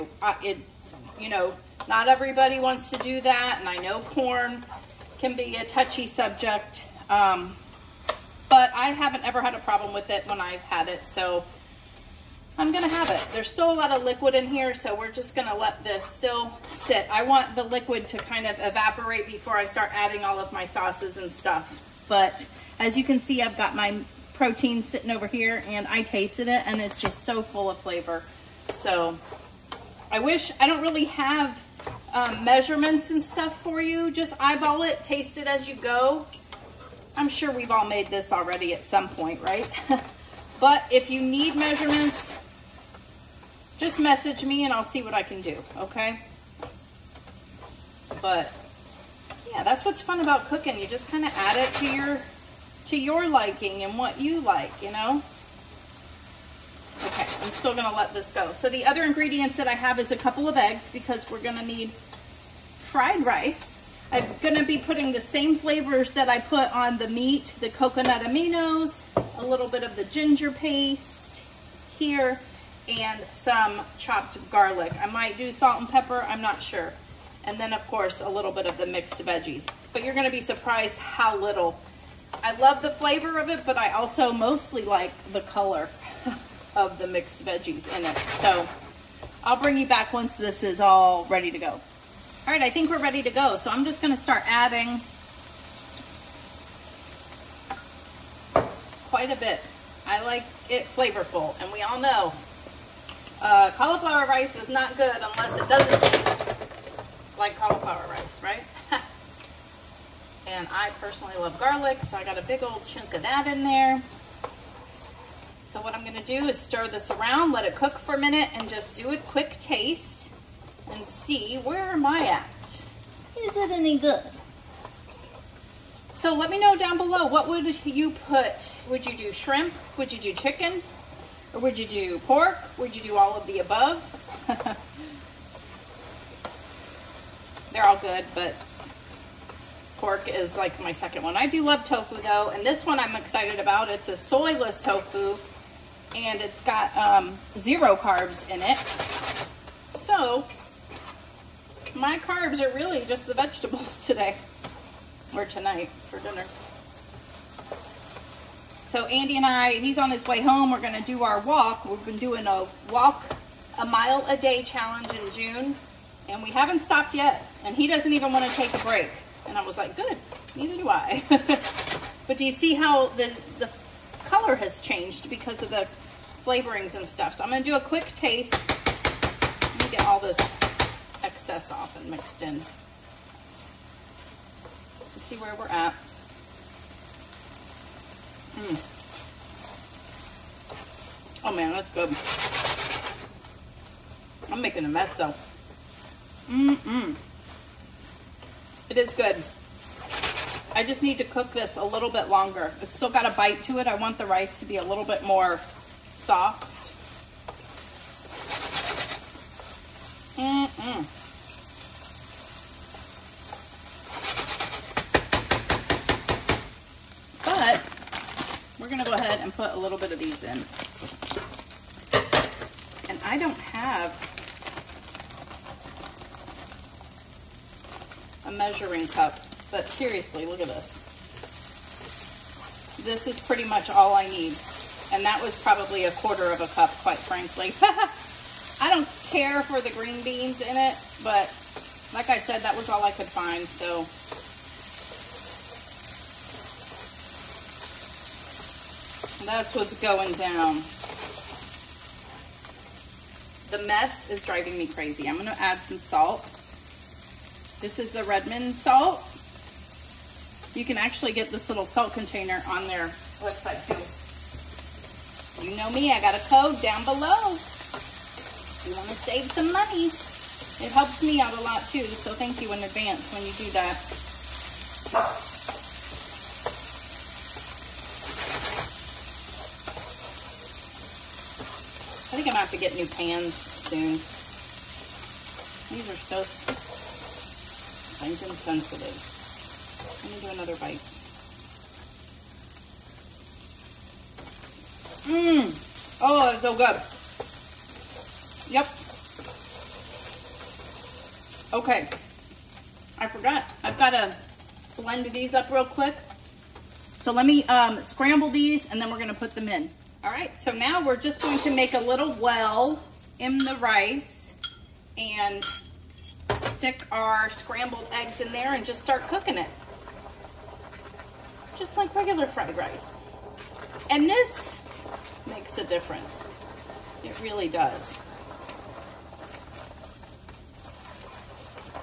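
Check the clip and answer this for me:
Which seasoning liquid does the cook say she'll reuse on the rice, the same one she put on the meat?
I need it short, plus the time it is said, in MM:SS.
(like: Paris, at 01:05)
coconut aminos, at 01:07.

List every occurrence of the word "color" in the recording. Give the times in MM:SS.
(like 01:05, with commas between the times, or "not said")
01:25, 02:54.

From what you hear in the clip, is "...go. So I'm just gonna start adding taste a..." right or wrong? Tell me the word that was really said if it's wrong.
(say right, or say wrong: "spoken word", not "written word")
wrong: "quite", not "taste".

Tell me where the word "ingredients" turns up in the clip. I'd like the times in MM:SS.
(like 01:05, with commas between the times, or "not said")
00:59.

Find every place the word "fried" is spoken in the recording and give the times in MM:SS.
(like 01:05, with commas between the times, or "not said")
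01:01, 05:22.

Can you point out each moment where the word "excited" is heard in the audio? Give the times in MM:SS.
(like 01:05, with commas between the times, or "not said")
02:23.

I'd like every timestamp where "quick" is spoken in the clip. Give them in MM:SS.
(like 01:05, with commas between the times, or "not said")
01:59, 02:57, 05:05.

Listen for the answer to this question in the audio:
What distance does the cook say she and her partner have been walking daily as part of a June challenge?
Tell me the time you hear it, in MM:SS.
02:43.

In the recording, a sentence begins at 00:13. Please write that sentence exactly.
There's still a lot of liquid in here, so we're just gonna let this still sit.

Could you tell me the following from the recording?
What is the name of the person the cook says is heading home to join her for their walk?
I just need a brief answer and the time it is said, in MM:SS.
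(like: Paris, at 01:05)
Andy, at 02:39.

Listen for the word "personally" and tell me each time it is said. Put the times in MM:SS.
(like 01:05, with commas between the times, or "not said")
01:50.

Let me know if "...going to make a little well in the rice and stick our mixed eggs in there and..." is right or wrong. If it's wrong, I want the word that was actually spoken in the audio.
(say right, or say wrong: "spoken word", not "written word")
wrong: "scrambled", not "mixed".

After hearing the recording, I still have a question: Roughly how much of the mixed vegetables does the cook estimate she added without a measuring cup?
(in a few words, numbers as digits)
a quarter of a cup.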